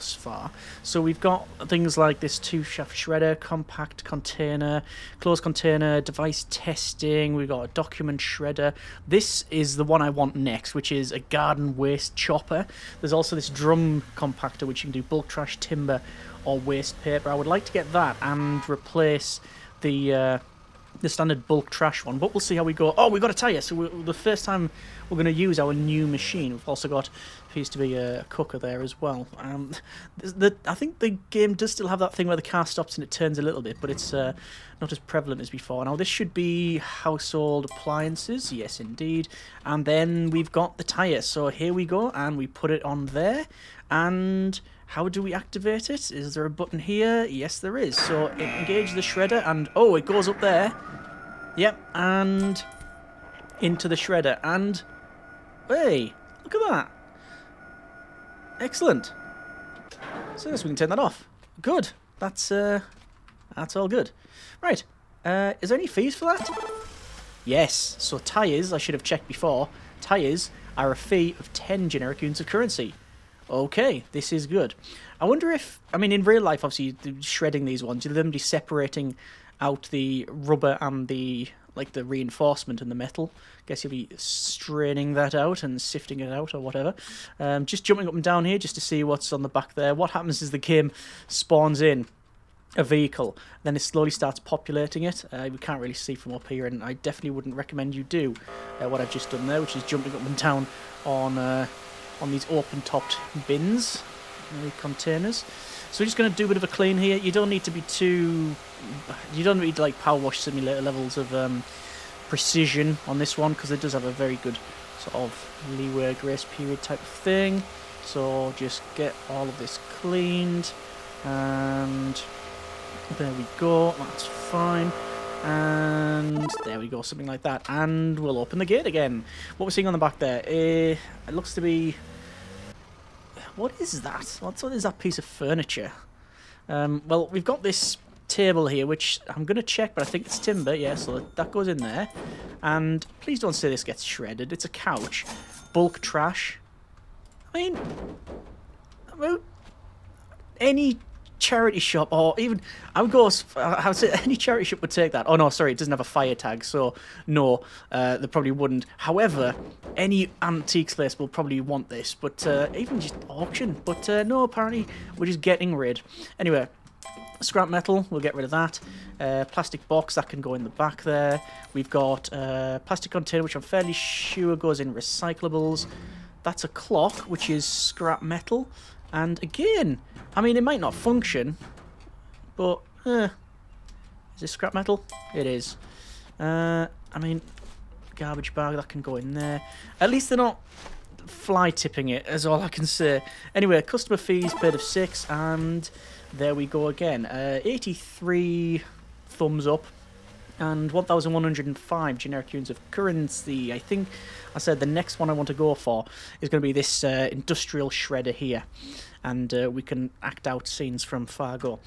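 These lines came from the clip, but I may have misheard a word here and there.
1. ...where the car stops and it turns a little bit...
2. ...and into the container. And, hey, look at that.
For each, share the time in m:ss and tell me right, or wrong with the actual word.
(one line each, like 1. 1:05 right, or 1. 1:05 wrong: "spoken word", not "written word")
1. 0:32 right
2. 0:51 wrong: "shredder", not "container".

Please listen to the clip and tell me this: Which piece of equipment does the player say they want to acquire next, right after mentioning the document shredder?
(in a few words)
Garden waste chopper.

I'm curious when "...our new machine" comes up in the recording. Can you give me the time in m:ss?
0:25.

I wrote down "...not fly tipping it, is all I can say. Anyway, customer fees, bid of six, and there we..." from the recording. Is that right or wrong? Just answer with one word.
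right.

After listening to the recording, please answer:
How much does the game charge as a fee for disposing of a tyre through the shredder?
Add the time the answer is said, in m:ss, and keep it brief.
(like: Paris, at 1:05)
10, at 1:11.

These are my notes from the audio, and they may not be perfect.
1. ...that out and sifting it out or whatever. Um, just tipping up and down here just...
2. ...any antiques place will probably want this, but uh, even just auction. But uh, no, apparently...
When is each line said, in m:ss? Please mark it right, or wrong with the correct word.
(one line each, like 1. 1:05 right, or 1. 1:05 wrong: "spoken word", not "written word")
1. 1:25 wrong: "jumping", not "tipping"
2. 2:39 right.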